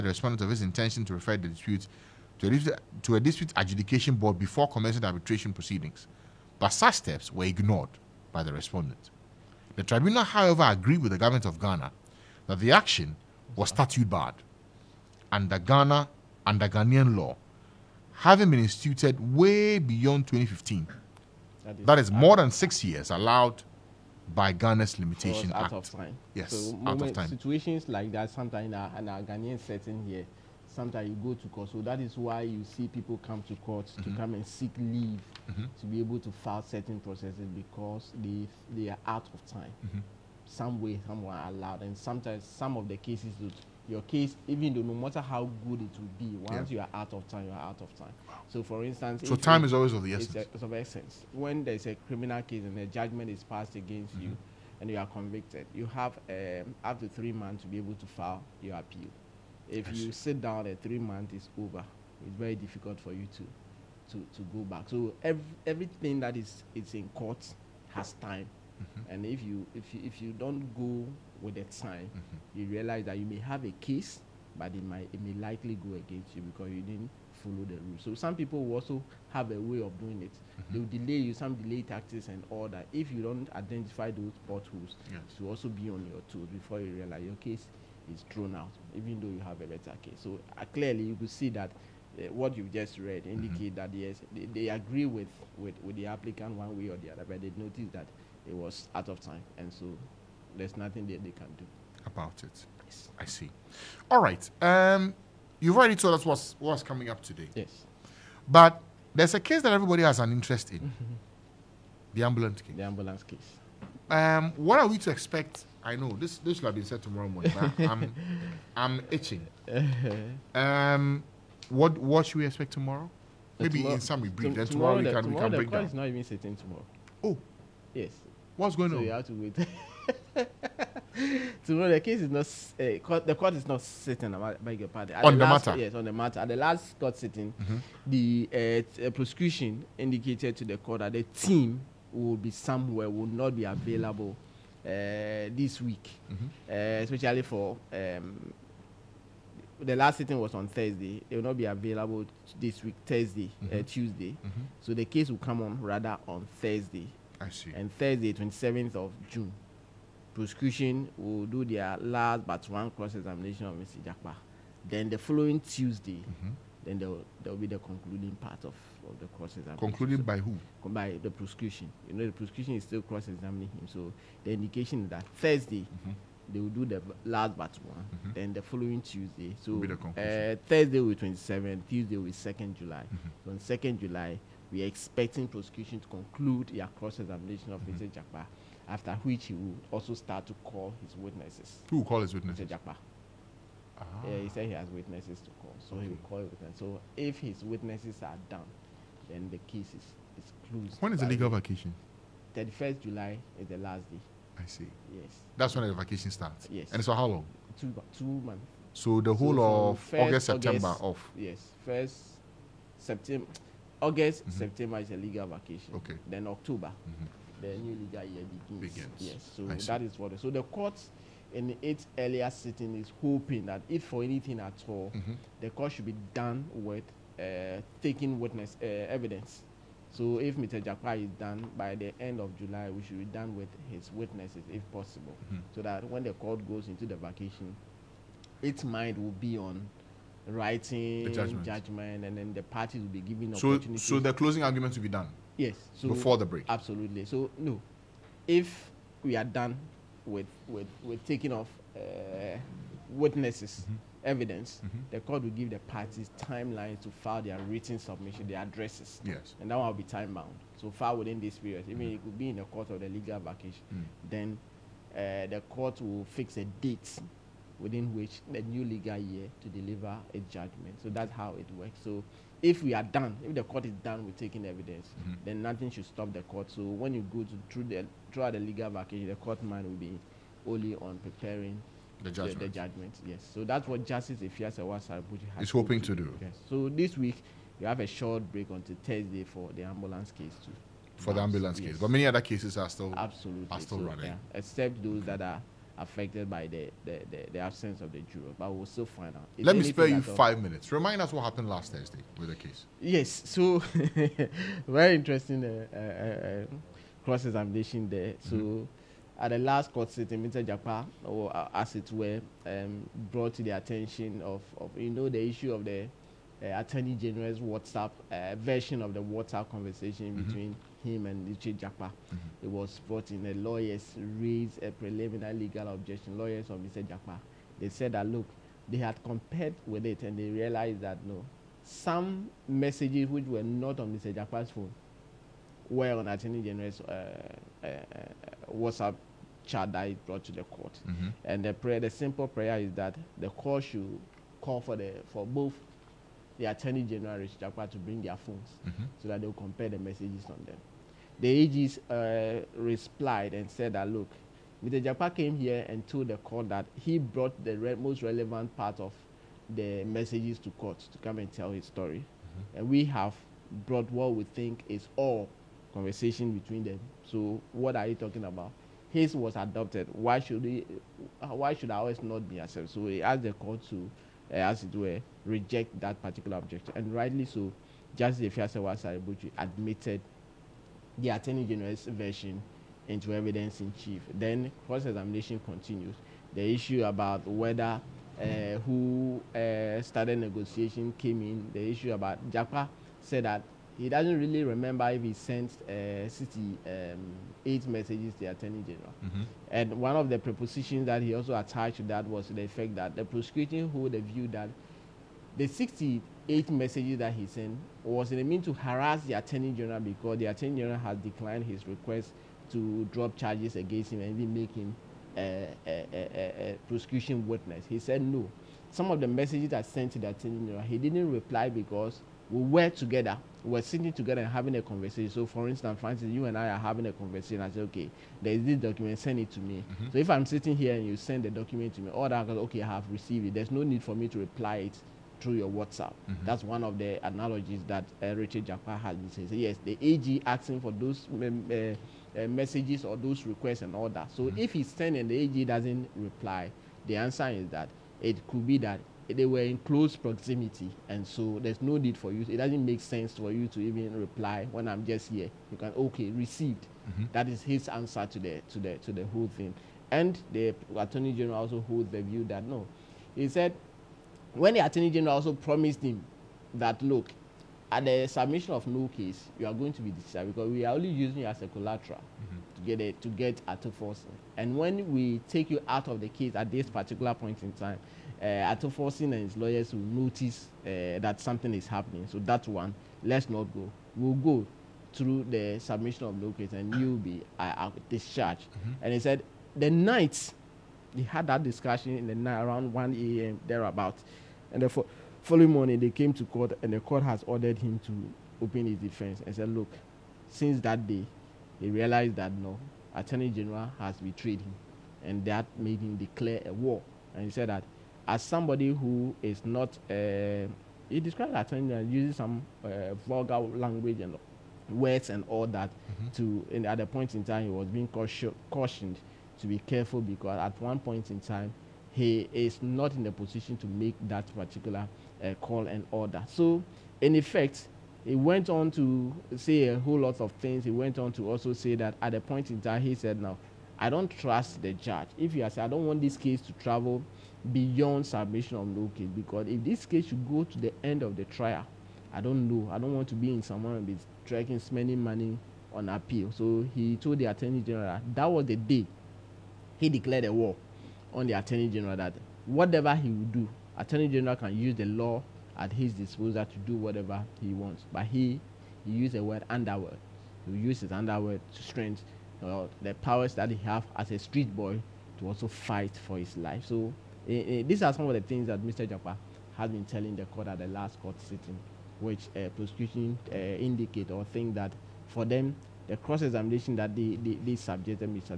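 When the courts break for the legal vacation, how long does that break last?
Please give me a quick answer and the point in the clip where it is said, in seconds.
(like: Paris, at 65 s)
Two months, at 207 s.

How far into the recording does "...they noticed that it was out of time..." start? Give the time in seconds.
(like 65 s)
97 s.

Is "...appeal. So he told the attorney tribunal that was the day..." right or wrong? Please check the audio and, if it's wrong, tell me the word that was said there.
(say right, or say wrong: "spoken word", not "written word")
wrong: "general", not "tribunal".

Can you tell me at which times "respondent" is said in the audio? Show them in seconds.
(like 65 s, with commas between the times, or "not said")
0 s, 8 s.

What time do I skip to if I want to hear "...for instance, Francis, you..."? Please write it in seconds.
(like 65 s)
425 s.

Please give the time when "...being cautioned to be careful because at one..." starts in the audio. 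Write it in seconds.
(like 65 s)
517 s.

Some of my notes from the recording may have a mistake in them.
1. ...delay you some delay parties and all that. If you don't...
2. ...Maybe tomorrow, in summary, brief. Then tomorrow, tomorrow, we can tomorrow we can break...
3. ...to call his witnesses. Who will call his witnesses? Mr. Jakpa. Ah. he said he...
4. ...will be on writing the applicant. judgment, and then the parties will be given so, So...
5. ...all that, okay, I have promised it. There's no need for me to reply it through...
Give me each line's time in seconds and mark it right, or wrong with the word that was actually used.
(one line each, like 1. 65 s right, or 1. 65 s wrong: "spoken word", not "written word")
1. 81 s wrong: "taxes", not "parties"
2. 123 s right
3. 190 s right
4. 239 s wrong: "judgment", not "applicant"
5. 432 s wrong: "received", not "promised".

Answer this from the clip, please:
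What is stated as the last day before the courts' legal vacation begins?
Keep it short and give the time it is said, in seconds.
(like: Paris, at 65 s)
31st July, at 202 s.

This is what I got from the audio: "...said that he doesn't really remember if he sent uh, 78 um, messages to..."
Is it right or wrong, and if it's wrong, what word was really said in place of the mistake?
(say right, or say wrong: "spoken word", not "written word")
wrong: "68", not "78".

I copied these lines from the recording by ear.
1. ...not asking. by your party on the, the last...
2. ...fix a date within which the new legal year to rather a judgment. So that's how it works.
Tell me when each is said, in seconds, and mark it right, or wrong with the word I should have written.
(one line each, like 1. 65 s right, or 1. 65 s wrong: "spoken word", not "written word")
1. 133 s wrong: "sitting", not "asking"
2. 266 s wrong: "deliver", not "rather".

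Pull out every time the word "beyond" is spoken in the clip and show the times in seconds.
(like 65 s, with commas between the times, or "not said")
19 s, 537 s.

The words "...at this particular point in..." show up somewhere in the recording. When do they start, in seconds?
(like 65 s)
476 s.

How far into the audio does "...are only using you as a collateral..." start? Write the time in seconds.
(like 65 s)
470 s.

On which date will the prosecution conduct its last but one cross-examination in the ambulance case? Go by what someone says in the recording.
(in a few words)
27th of June.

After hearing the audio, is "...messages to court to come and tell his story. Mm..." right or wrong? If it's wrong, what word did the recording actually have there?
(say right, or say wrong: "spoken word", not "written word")
right.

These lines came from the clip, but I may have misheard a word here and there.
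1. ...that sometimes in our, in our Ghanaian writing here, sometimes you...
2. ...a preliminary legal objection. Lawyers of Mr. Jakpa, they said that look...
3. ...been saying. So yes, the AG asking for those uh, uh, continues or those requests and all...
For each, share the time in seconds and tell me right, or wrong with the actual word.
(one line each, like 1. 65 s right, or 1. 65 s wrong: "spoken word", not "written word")
1. 28 s wrong: "setting", not "writing"
2. 324 s right
3. 439 s wrong: "messages", not "continues".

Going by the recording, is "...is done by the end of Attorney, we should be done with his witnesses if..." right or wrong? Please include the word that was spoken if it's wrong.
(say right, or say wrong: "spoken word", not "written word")
wrong: "July", not "Attorney".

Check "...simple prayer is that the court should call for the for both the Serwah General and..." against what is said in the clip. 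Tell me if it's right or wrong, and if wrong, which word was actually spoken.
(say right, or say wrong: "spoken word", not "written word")
wrong: "Attorney", not "Serwah".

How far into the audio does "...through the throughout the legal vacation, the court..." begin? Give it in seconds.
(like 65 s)
277 s.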